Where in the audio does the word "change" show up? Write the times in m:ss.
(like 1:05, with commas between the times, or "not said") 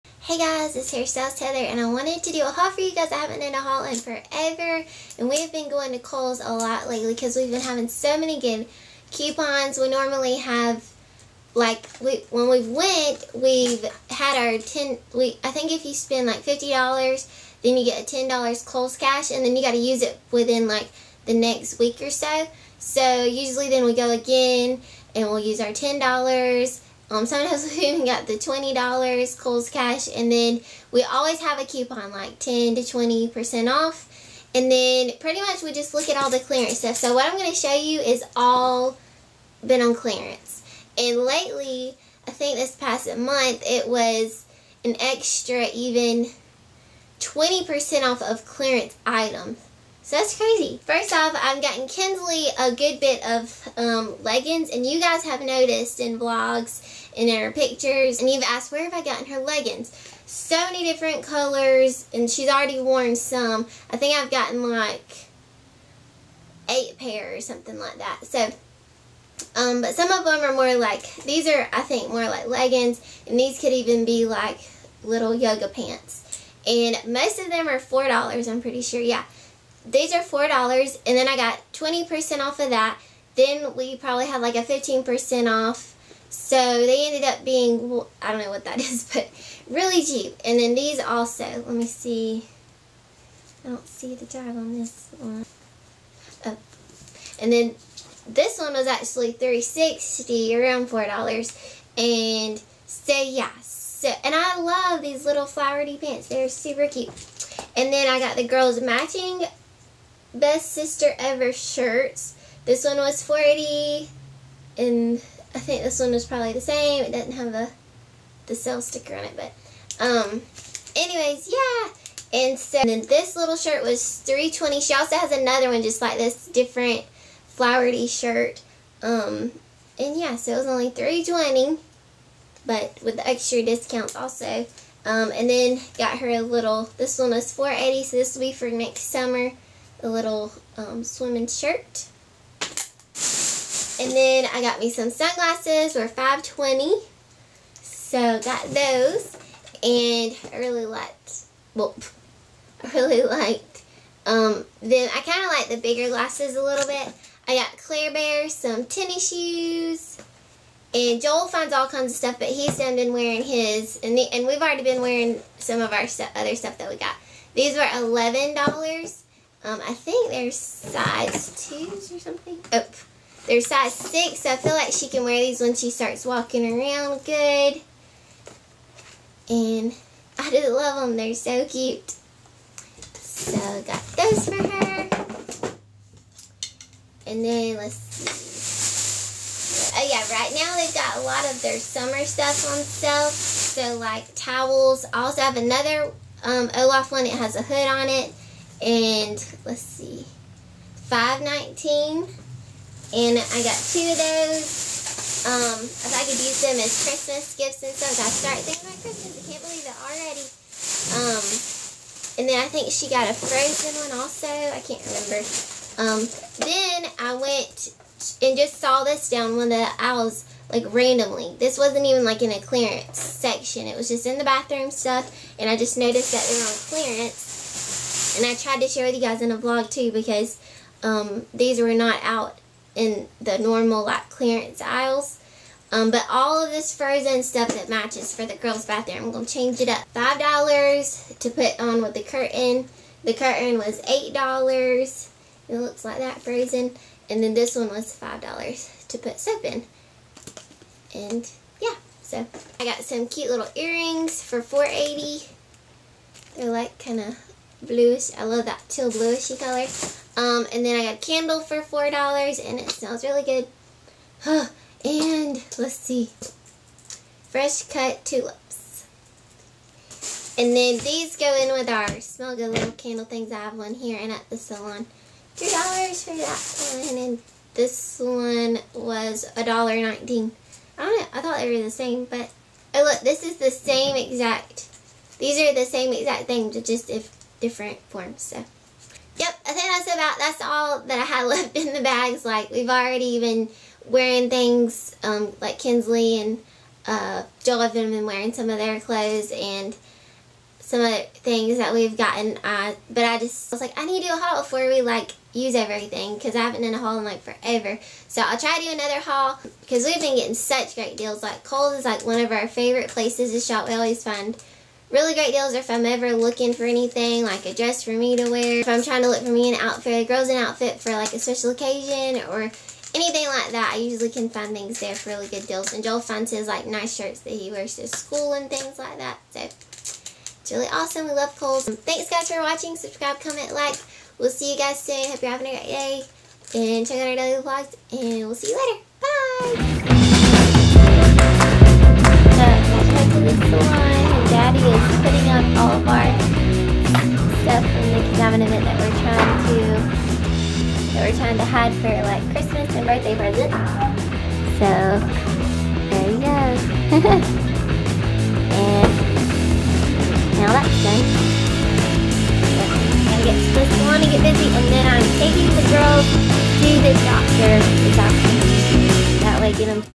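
3:59.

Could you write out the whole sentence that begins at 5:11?
Like Kohl's is like one of our favorite places to shop.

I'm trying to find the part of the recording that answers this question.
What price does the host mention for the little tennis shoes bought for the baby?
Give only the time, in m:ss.
2:47.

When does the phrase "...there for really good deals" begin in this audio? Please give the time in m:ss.
5:24.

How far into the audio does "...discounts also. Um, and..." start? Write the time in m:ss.
2:13.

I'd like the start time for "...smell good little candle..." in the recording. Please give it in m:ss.
4:32.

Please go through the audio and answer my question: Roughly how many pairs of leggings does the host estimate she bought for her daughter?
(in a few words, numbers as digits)
8.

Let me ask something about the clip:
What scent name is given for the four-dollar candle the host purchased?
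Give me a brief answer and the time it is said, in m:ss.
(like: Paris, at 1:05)
Fresh cut tulips, at 4:27.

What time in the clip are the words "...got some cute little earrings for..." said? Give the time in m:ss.
4:12.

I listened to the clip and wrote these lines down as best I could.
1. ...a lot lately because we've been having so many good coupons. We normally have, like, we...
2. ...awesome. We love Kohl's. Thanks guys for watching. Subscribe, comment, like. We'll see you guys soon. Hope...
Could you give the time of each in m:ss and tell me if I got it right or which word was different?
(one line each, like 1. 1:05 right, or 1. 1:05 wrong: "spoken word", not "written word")
1. 0:06 right
2. 5:30 right.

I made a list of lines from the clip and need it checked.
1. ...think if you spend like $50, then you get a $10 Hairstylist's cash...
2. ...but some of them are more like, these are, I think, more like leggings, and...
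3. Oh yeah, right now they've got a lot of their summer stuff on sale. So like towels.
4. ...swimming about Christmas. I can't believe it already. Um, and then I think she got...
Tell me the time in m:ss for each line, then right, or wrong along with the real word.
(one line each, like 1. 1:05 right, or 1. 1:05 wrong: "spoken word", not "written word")
1. 0:15 wrong: "Kohl", not "Hairstylist"
2. 1:09 right
3. 3:09 right
4. 3:28 wrong: "thinking", not "swimming".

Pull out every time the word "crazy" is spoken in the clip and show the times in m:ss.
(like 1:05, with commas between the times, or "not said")
0:50.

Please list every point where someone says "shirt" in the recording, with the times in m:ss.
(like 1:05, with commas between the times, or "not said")
1:51, 2:03, 2:08, 2:21, 5:27.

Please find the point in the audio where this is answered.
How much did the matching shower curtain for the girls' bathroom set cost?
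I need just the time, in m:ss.
4:04.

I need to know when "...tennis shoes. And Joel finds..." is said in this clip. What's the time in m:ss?
2:38.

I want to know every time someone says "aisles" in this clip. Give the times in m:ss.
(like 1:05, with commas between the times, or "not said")
3:39, 3:54.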